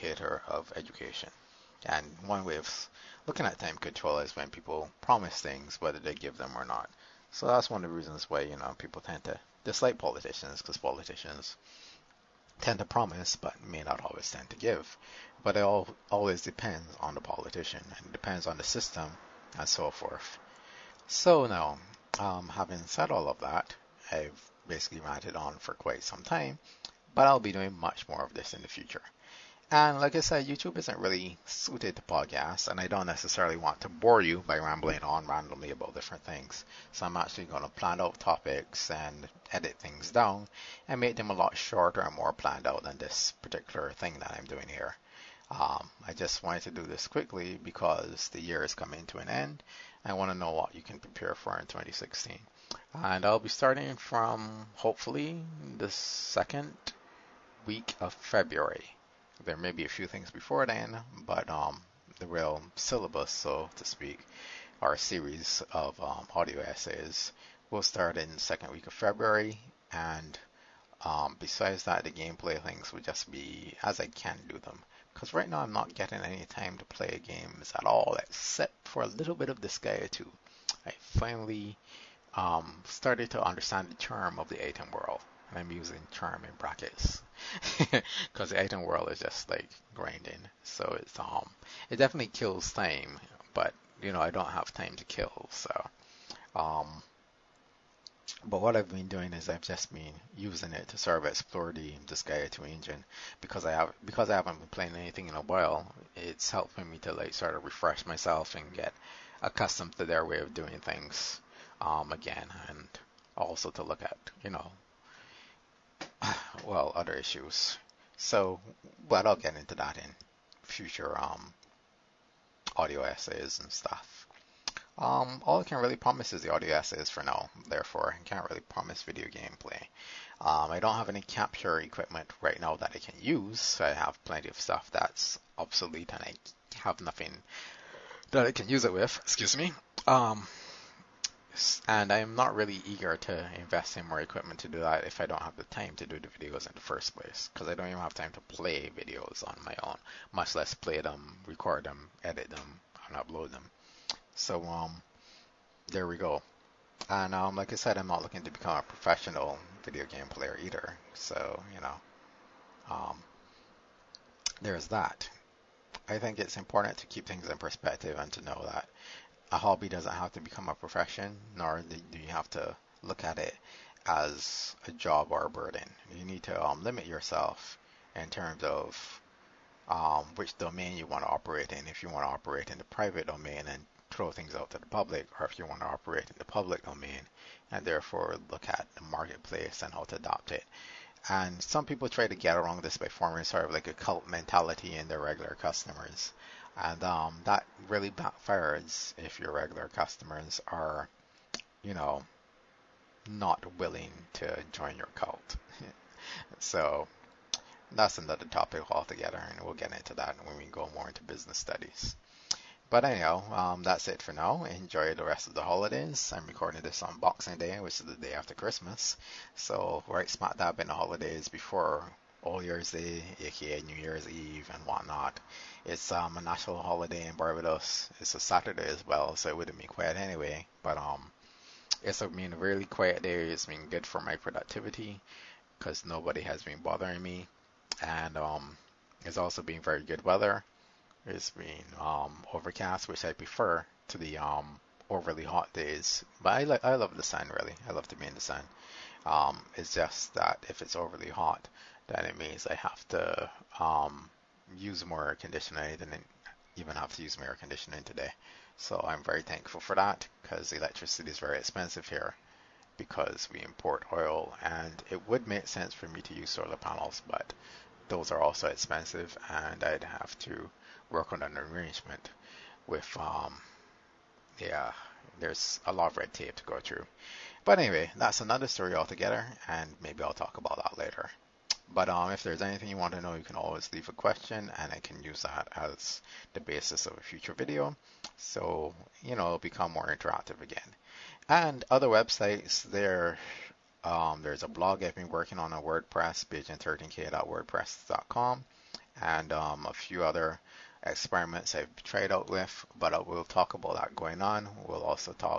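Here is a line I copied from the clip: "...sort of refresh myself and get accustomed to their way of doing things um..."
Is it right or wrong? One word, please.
right.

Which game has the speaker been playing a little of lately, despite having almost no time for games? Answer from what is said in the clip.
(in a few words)
Disgaea 2.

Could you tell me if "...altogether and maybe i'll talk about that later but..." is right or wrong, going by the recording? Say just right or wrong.
right.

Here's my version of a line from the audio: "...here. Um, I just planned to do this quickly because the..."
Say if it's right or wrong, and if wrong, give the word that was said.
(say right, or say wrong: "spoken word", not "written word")
wrong: "wanted", not "planned".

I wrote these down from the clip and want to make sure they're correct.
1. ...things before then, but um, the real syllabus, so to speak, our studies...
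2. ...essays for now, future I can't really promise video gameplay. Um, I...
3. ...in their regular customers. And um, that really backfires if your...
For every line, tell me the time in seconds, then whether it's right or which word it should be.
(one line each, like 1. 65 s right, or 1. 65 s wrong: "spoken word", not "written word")
1. 60 s wrong: "series", not "studies"
2. 126 s wrong: "therefore", not "future"
3. 194 s right.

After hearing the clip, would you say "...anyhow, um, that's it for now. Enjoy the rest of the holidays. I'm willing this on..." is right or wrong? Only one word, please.
wrong.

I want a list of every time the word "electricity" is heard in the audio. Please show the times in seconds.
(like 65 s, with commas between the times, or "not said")
260 s.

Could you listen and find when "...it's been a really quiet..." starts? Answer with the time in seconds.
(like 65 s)
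232 s.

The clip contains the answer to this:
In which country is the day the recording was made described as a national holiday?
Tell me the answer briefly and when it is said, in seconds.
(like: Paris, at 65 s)
Barbados, at 227 s.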